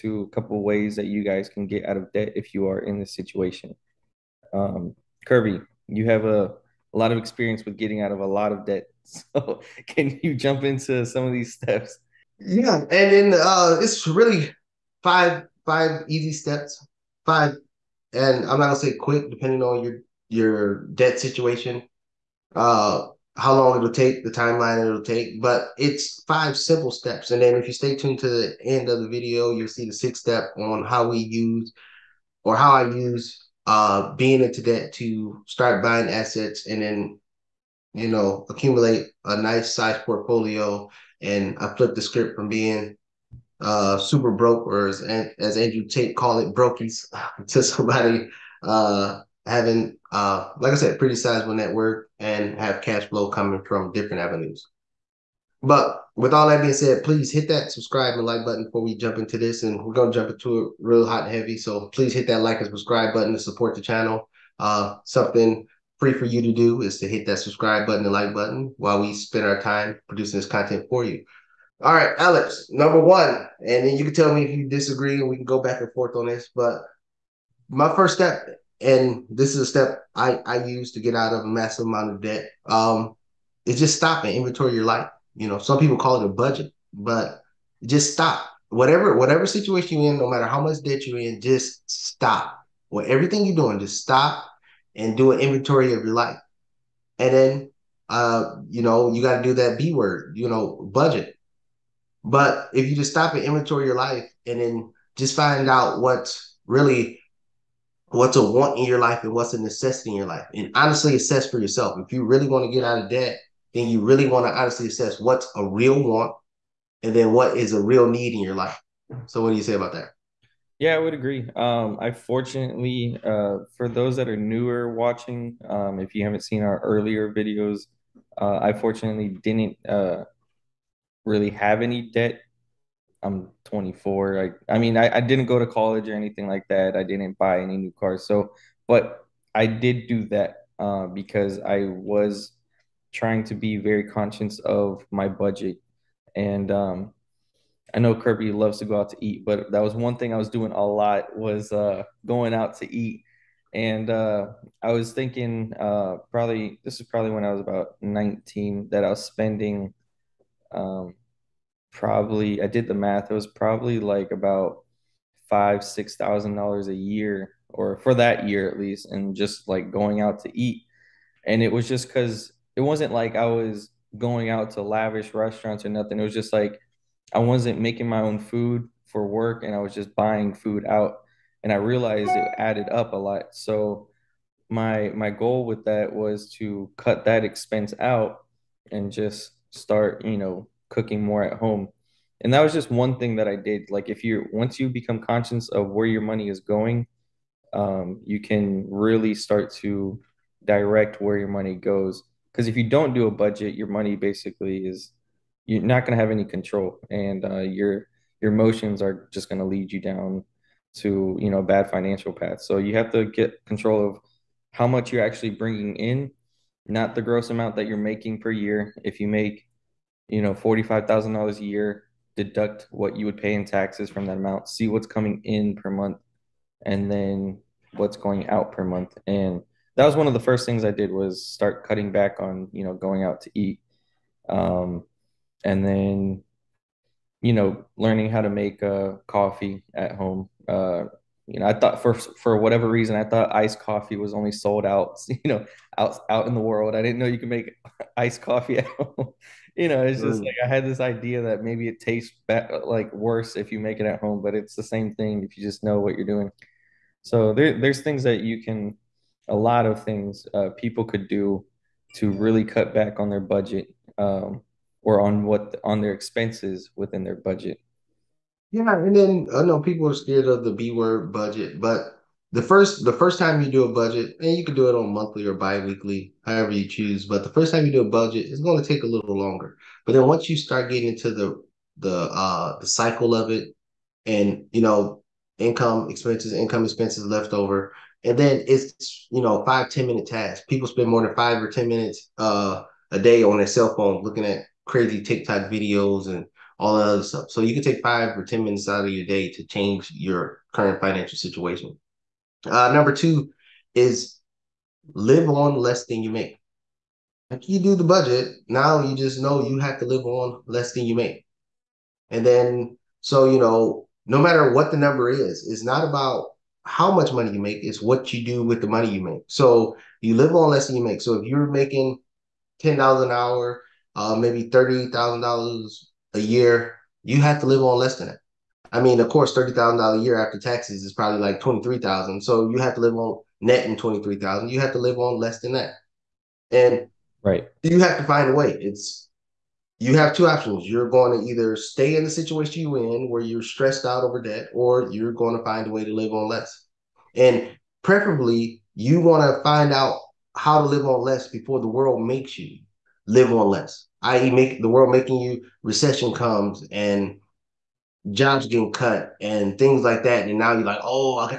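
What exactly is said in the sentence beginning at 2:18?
So, but I did do that uh, because I was trying to be very conscious of my budget.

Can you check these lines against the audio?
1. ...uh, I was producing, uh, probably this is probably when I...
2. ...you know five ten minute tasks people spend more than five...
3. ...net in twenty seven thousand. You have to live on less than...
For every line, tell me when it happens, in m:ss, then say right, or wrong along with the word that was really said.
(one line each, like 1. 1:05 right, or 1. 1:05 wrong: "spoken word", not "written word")
1. 2:34 wrong: "thinking", not "producing"
2. 4:49 right
3. 5:33 wrong: "three", not "seven".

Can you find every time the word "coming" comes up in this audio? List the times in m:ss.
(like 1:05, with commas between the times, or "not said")
0:53, 3:45.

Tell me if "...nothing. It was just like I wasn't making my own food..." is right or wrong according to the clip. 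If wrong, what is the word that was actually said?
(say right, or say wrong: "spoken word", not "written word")
right.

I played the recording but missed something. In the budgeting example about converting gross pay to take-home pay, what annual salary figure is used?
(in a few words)
$45,000.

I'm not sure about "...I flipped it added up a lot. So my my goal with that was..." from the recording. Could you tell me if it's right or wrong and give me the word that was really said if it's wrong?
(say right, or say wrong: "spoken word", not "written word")
wrong: "realized", not "flipped".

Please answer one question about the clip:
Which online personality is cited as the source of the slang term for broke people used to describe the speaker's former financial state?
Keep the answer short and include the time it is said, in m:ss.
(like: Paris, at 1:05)
Andrew Tate, at 0:45.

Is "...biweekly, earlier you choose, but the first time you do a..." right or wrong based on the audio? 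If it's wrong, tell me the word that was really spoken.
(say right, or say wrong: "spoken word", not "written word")
wrong: "however", not "earlier".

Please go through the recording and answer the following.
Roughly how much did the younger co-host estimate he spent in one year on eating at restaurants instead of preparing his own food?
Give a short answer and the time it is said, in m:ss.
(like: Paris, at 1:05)
5,000 to 6,000 dollars, at 2:45.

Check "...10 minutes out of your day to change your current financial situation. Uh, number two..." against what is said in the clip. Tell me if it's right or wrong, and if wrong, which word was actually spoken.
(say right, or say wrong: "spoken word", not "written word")
right.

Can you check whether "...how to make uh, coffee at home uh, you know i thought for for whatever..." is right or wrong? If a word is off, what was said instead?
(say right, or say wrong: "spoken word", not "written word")
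right.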